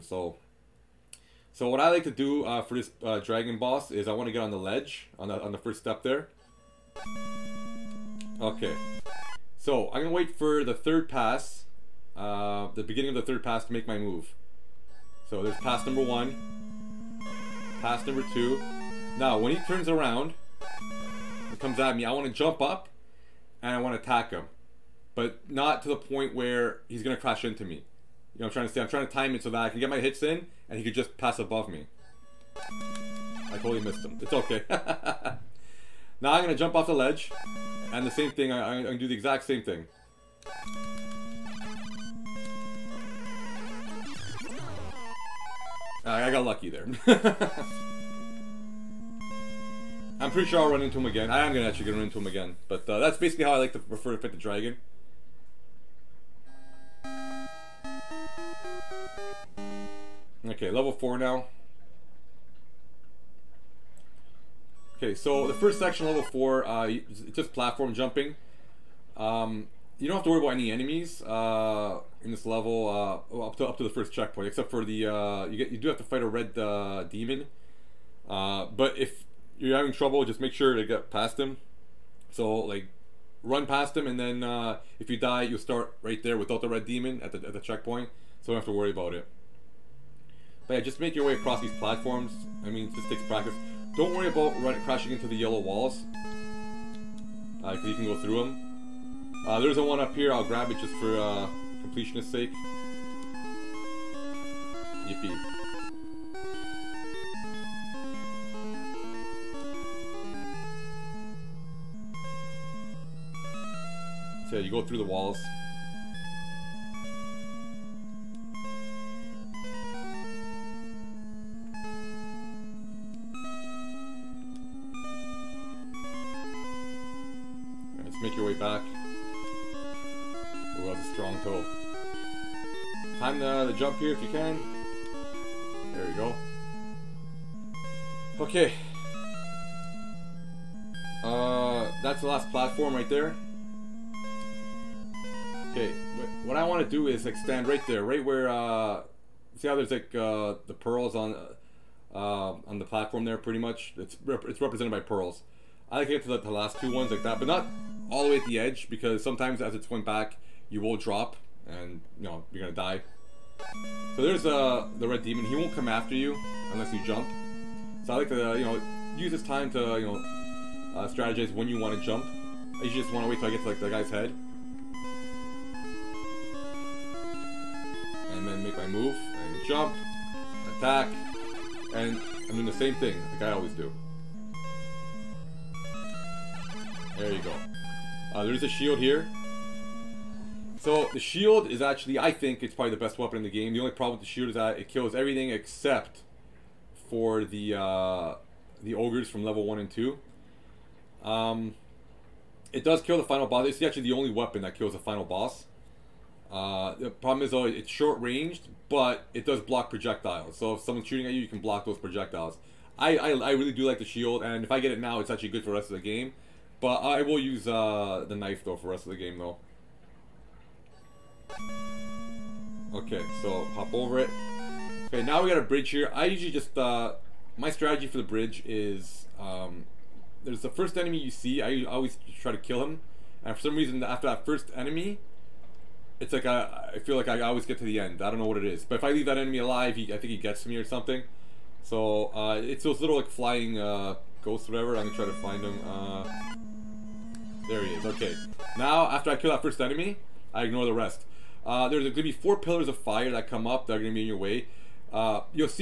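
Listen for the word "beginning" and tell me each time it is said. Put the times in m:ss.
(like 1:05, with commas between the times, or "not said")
0:12.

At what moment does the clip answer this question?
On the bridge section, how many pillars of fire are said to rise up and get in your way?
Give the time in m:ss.
4:12.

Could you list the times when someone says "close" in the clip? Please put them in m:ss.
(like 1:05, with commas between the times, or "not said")
not said.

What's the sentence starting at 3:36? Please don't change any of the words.
But I will use uh, the knife though for the rest of the game though.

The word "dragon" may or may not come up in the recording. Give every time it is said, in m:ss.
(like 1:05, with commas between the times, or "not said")
0:03, 0:54.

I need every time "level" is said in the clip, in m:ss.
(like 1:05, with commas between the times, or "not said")
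1:00, 1:06, 1:12, 3:19.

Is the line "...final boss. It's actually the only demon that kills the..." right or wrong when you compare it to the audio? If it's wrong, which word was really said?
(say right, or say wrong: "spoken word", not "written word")
wrong: "weapon", not "demon".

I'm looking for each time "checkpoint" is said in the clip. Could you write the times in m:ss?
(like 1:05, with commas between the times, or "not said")
1:14, 1:27.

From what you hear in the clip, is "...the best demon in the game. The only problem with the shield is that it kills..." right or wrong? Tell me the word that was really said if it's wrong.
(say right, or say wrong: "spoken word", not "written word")
wrong: "weapon", not "demon".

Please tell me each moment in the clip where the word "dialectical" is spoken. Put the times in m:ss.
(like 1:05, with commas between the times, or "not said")
not said.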